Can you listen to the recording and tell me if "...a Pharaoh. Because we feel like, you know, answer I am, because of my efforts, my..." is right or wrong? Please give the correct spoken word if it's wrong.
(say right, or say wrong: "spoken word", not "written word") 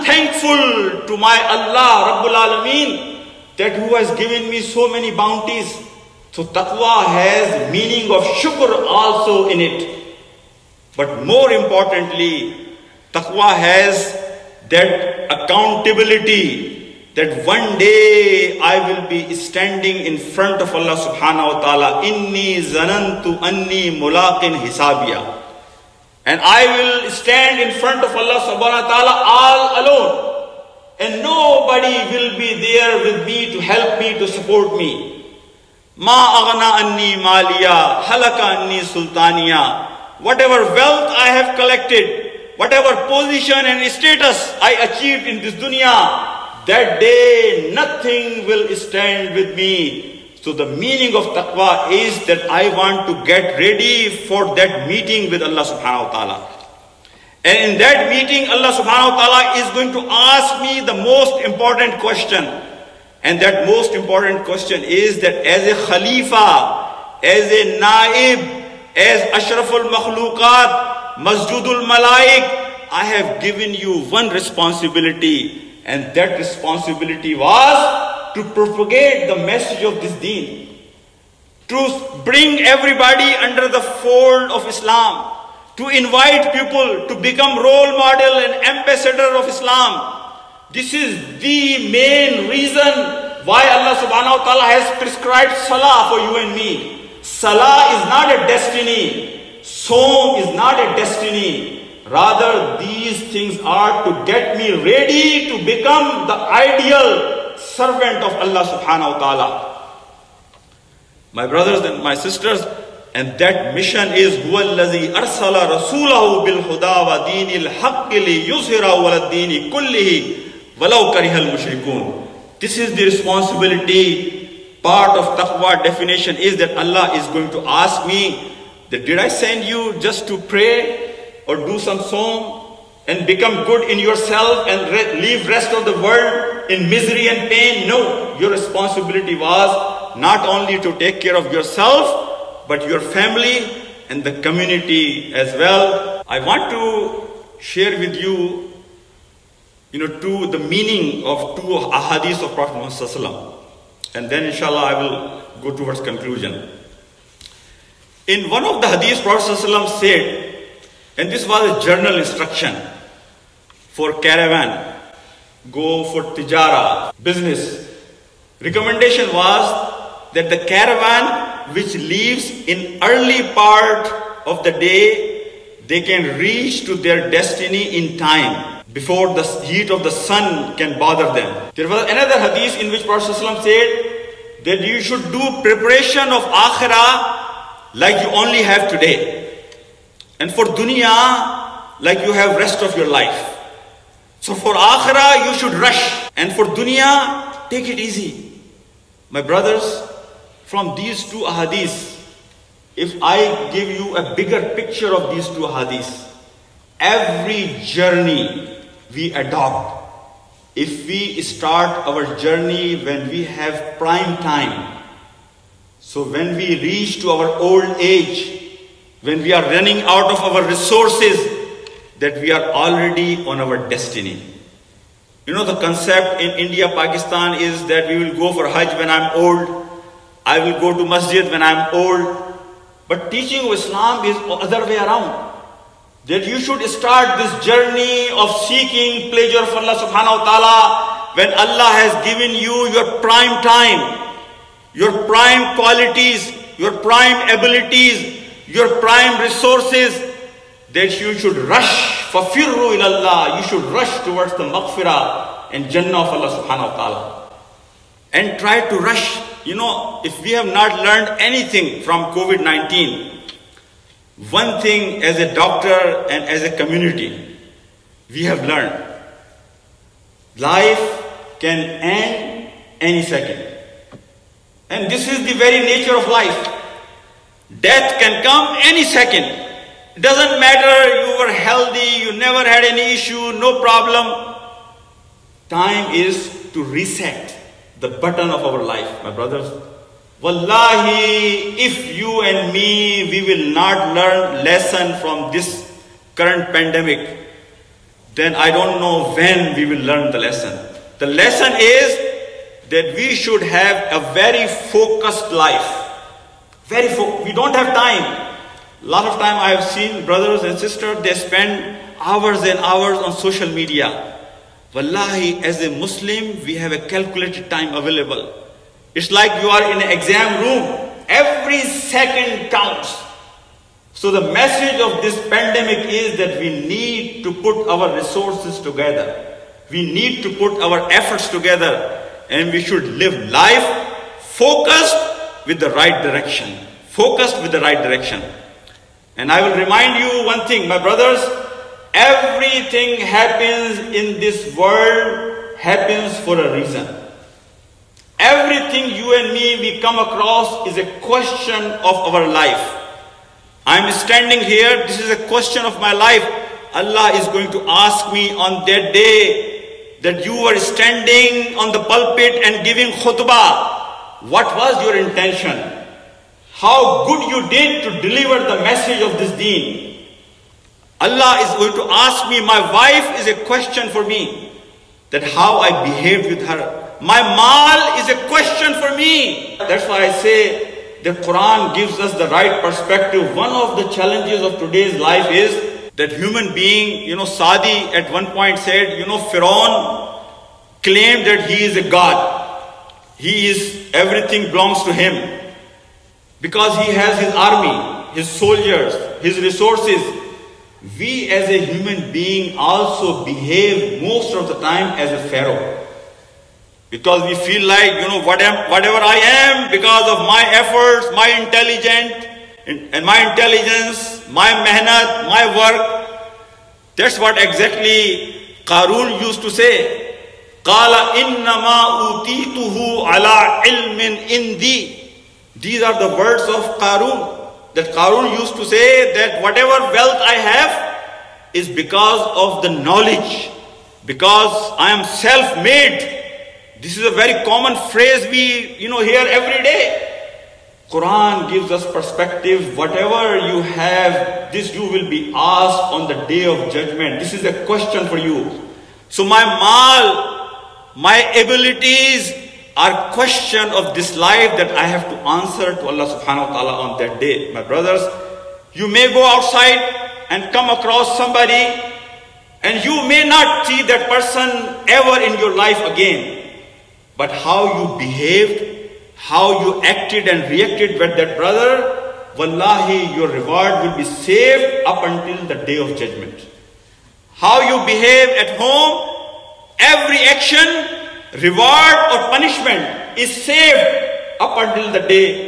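wrong: "whatever", not "answer".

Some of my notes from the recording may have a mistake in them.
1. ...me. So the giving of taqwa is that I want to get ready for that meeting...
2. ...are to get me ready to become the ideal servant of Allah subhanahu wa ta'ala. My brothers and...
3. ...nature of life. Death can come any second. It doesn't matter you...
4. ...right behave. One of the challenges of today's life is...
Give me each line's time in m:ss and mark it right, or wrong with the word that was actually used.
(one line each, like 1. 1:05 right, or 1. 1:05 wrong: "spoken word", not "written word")
1. 0:49 wrong: "meaning", not "giving"
2. 1:43 right
3. 4:35 right
4. 6:22 wrong: "perspective", not "behave".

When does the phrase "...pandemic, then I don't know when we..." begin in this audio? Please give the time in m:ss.
4:56.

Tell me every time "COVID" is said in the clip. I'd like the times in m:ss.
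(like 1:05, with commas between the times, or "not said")
4:22.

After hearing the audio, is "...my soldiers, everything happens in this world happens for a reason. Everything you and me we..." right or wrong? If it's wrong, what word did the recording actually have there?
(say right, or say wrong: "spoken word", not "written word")
wrong: "brothers", not "soldiers".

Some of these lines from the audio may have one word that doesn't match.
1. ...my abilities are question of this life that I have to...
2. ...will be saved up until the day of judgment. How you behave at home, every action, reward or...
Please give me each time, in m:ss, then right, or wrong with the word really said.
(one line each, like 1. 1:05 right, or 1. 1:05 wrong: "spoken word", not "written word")
1. 7:31 right
2. 7:54 right.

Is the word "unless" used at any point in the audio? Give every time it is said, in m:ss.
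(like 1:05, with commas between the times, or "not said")
not said.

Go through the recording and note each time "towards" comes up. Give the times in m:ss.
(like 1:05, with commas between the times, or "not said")
2:35, 4:14.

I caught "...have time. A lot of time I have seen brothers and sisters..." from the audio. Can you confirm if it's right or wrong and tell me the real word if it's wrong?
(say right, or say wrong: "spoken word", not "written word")
right.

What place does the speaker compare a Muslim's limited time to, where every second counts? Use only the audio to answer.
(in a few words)
An exam room.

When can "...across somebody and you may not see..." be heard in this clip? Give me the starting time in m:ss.
7:40.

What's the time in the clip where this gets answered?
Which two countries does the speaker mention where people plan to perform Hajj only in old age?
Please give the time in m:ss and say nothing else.
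3:46.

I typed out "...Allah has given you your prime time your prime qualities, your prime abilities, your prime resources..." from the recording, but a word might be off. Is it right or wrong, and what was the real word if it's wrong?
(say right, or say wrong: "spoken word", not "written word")
right.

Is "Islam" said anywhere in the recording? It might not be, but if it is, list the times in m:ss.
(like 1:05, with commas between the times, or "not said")
1:24, 1:29, 3:53.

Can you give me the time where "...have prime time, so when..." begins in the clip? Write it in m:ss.
3:33.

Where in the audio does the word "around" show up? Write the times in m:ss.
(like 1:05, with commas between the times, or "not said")
3:54.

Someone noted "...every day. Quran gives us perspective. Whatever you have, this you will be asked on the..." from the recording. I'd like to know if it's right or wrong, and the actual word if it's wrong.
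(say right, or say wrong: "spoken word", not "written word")
right.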